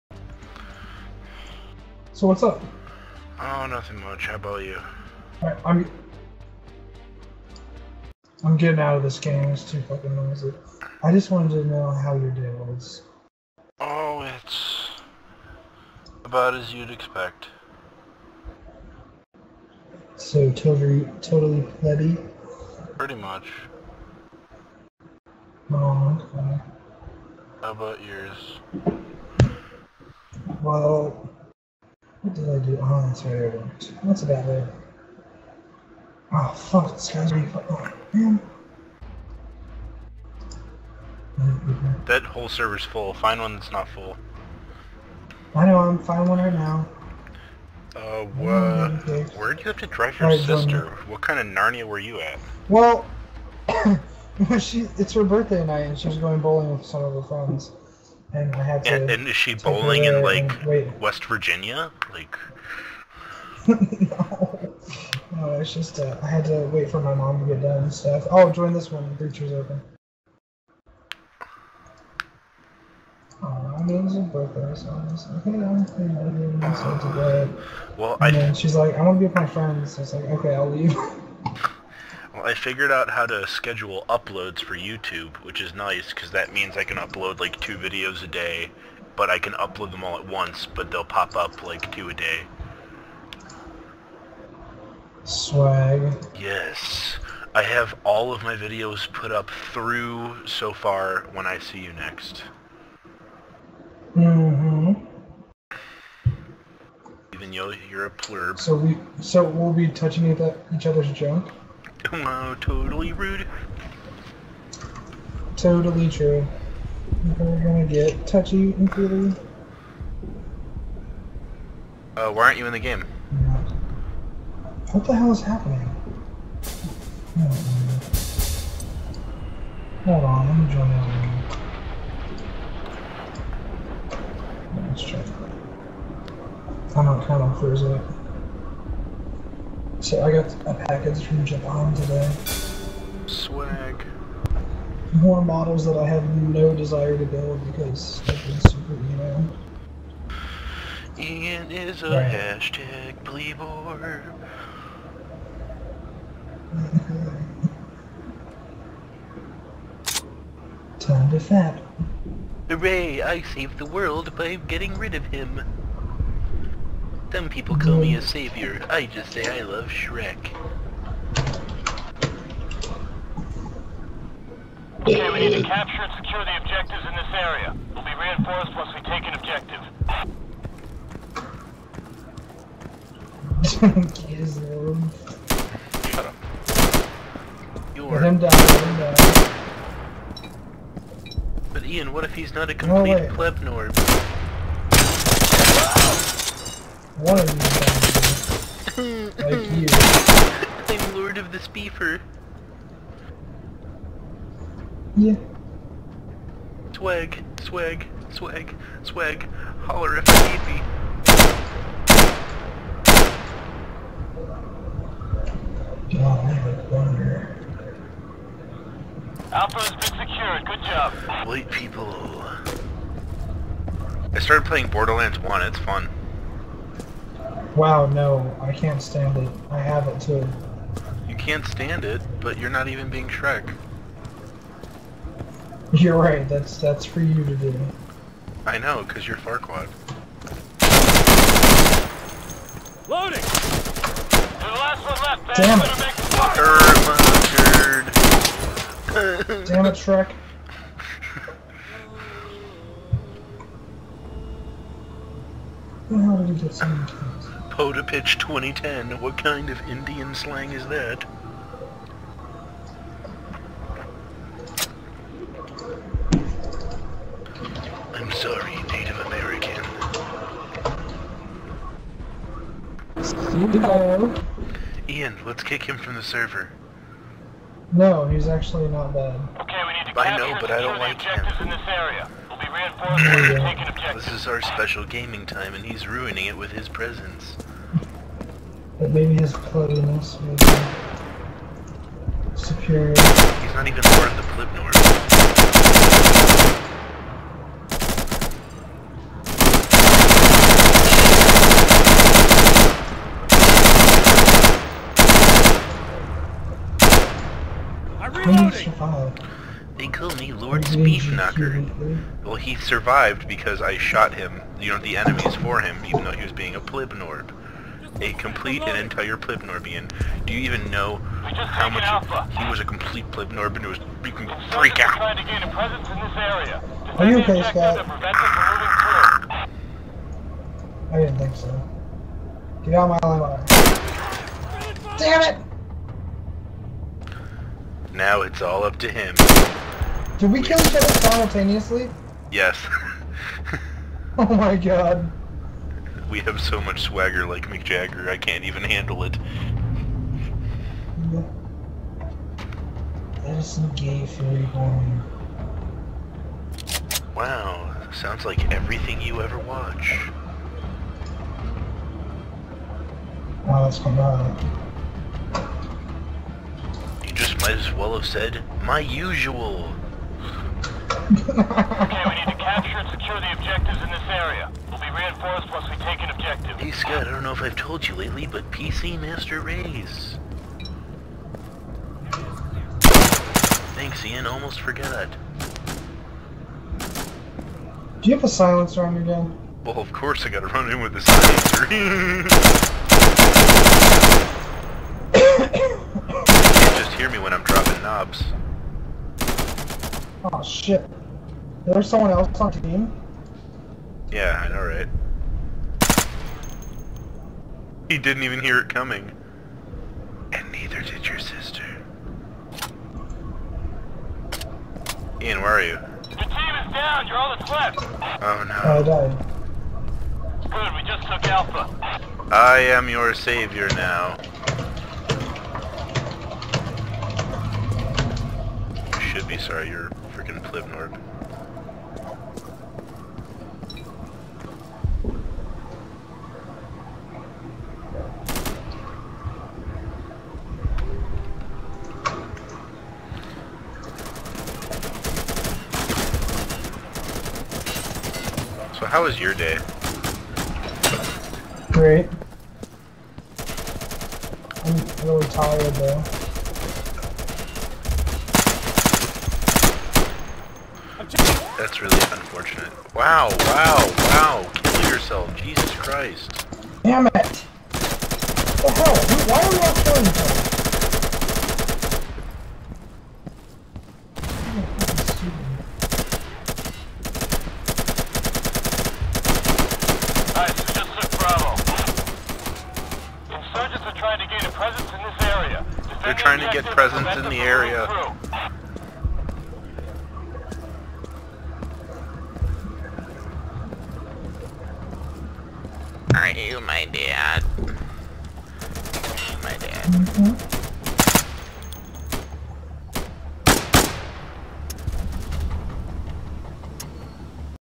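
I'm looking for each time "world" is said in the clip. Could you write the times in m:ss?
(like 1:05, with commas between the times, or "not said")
2:43.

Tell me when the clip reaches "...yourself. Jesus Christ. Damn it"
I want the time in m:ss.
7:45.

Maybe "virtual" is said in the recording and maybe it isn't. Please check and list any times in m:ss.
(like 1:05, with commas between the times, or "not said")
not said.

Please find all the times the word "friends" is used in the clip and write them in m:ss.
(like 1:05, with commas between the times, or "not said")
0:57, 1:19.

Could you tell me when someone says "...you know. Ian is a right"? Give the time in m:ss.
2:28.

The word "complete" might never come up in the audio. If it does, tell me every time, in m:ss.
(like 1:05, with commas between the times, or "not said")
3:12, 5:18, 5:22.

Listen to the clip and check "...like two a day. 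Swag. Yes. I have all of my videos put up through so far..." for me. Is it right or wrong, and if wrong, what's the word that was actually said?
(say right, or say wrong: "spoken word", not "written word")
right.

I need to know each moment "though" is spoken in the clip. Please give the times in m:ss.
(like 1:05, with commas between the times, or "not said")
1:47, 5:16, 7:35.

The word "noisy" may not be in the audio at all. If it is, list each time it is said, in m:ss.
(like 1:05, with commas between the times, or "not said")
0:10.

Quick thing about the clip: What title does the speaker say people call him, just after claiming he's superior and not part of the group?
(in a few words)
Lord Speedknocker.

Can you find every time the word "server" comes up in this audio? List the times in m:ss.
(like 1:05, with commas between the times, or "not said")
0:42, 4:36.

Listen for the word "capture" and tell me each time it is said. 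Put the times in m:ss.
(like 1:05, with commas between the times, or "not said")
2:55, 6:12.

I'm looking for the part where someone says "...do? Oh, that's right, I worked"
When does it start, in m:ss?
0:32.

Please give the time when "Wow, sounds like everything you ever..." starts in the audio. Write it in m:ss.
5:57.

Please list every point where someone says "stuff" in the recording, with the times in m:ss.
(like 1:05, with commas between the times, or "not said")
1:07.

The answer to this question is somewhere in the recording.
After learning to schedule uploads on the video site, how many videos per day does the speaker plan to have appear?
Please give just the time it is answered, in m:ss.
1:27.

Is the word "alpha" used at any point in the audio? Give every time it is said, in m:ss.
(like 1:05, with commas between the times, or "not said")
3:39, 5:22, 7:01.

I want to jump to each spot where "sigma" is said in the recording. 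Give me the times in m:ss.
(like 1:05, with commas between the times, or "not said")
not said.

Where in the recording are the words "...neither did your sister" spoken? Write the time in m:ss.
6:50.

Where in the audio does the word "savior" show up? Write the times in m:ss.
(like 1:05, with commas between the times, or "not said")
2:48, 7:03.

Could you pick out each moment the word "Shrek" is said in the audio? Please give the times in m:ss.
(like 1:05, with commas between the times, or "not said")
2:49, 3:53, 4:09.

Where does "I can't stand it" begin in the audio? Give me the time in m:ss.
3:48.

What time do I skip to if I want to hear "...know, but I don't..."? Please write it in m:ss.
4:40.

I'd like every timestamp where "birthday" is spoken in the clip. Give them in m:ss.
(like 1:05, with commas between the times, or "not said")
0:55, 1:14.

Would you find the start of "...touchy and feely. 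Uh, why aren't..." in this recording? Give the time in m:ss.
1:58.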